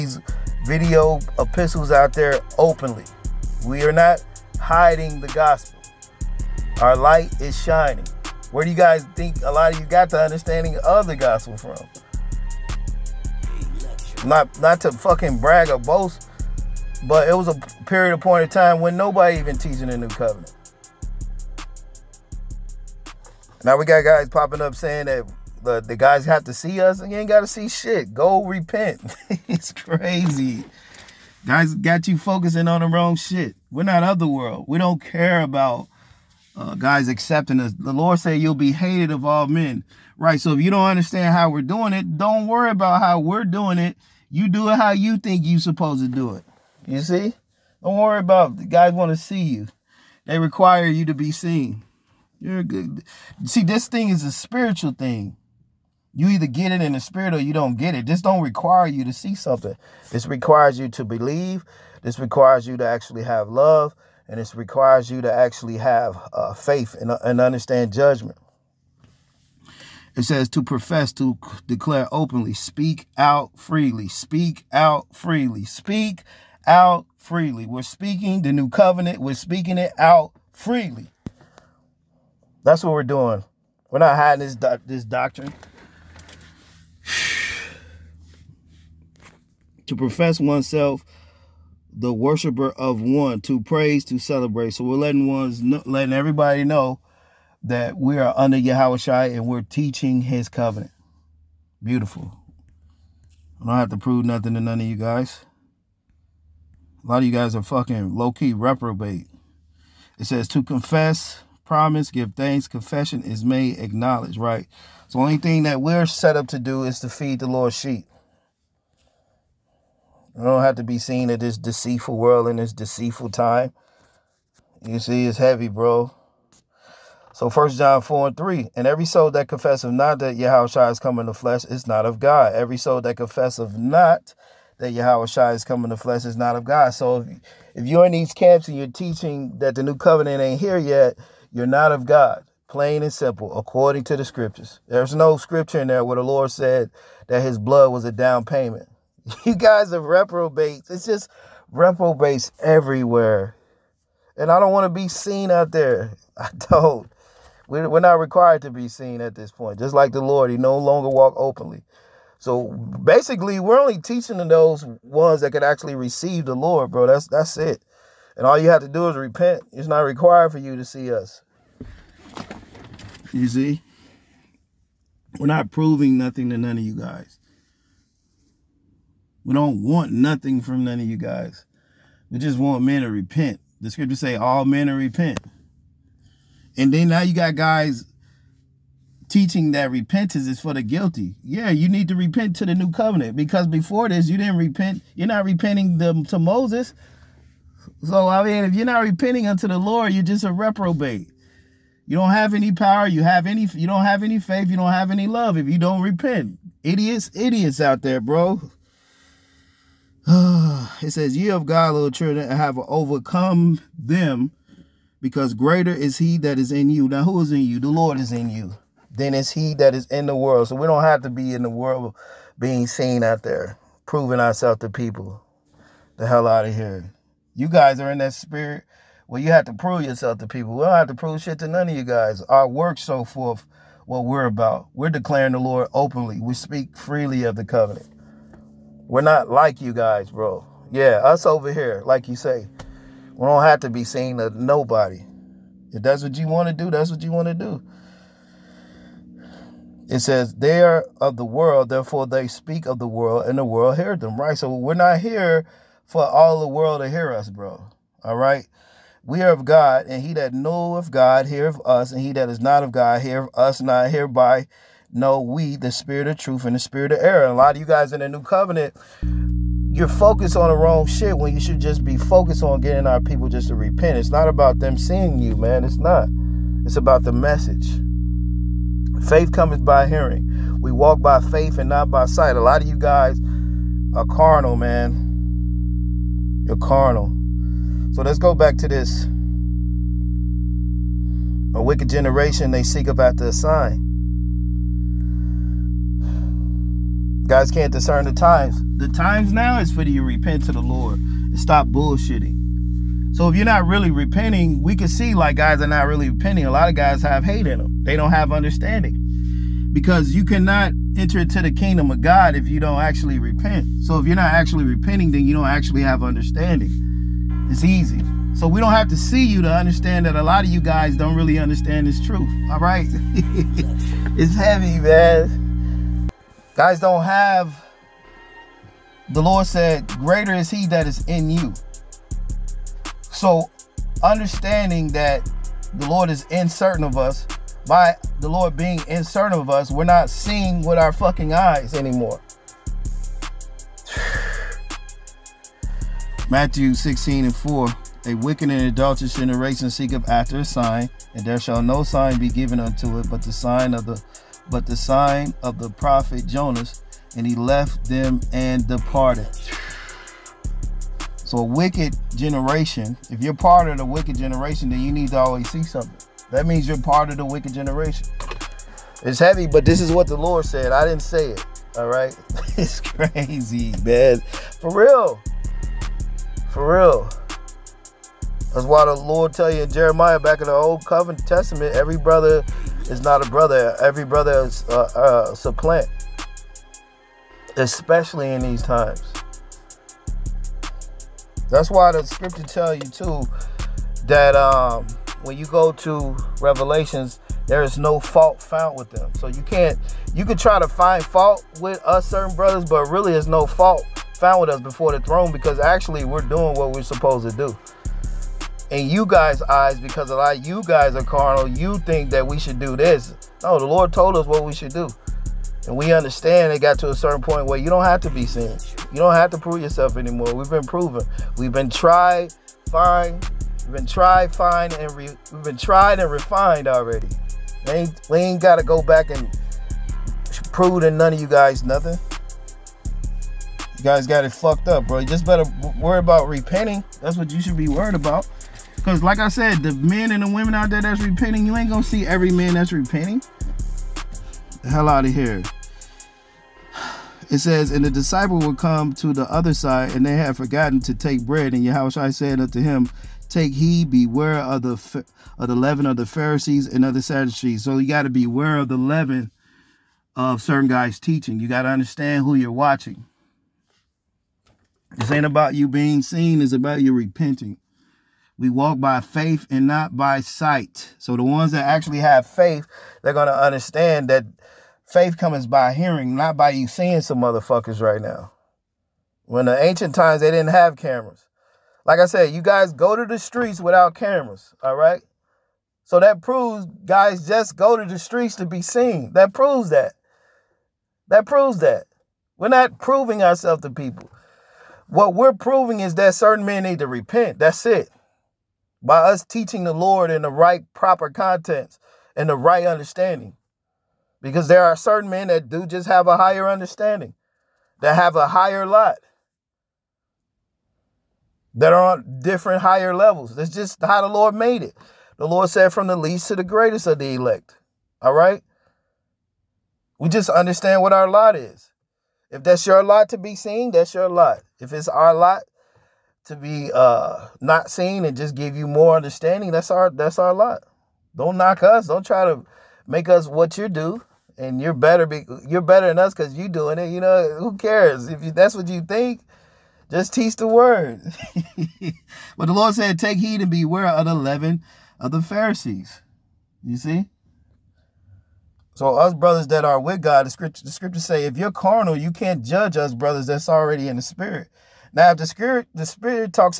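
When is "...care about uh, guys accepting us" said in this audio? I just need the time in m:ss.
0:34.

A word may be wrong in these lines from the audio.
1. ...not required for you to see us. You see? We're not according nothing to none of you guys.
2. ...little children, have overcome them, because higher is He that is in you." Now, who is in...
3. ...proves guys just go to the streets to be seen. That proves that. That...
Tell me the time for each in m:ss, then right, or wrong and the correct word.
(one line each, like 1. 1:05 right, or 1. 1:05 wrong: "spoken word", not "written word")
1. 2:49 wrong: "proving", not "according"
2. 3:31 wrong: "greater", not "higher"
3. 8:06 right.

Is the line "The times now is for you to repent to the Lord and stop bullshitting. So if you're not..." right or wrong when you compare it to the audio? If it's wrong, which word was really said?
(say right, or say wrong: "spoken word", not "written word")
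right.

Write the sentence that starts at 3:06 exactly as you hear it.
And then now you got guys teaching that repentance is for the guilty.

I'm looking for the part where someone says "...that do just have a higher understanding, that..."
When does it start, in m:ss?
8:25.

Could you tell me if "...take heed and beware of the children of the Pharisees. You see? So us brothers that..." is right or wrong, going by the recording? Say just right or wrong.
wrong.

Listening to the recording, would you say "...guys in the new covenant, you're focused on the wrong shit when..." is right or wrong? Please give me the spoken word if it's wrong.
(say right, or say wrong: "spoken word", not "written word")
right.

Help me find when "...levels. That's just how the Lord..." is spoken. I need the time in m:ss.
8:33.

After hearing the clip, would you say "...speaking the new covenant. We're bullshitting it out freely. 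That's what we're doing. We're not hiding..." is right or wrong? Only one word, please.
wrong.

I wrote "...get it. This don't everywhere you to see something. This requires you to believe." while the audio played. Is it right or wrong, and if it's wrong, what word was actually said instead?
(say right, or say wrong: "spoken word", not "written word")
wrong: "require", not "everywhere".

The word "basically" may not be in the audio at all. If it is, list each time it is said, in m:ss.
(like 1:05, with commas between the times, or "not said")
2:42.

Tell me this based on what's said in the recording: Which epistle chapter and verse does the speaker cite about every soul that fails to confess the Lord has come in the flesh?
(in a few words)
First John 4:3.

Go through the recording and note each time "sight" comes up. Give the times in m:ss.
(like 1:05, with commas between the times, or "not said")
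4:42, 7:50.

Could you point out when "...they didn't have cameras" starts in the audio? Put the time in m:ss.
8:00.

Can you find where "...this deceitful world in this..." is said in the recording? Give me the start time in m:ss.
2:01.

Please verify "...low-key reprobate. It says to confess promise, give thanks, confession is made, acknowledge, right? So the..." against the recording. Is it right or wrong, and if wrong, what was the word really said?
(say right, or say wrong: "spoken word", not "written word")
right.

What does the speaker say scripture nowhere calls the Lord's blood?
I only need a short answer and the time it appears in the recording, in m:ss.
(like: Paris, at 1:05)
a down payment, at 2:28.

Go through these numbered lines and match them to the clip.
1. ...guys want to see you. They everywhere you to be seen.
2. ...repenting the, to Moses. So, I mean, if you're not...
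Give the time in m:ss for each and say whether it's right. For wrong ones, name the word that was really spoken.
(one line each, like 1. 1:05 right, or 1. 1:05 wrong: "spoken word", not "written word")
1. 0:48 wrong: "require", not "everywhere"
2. 3:15 right.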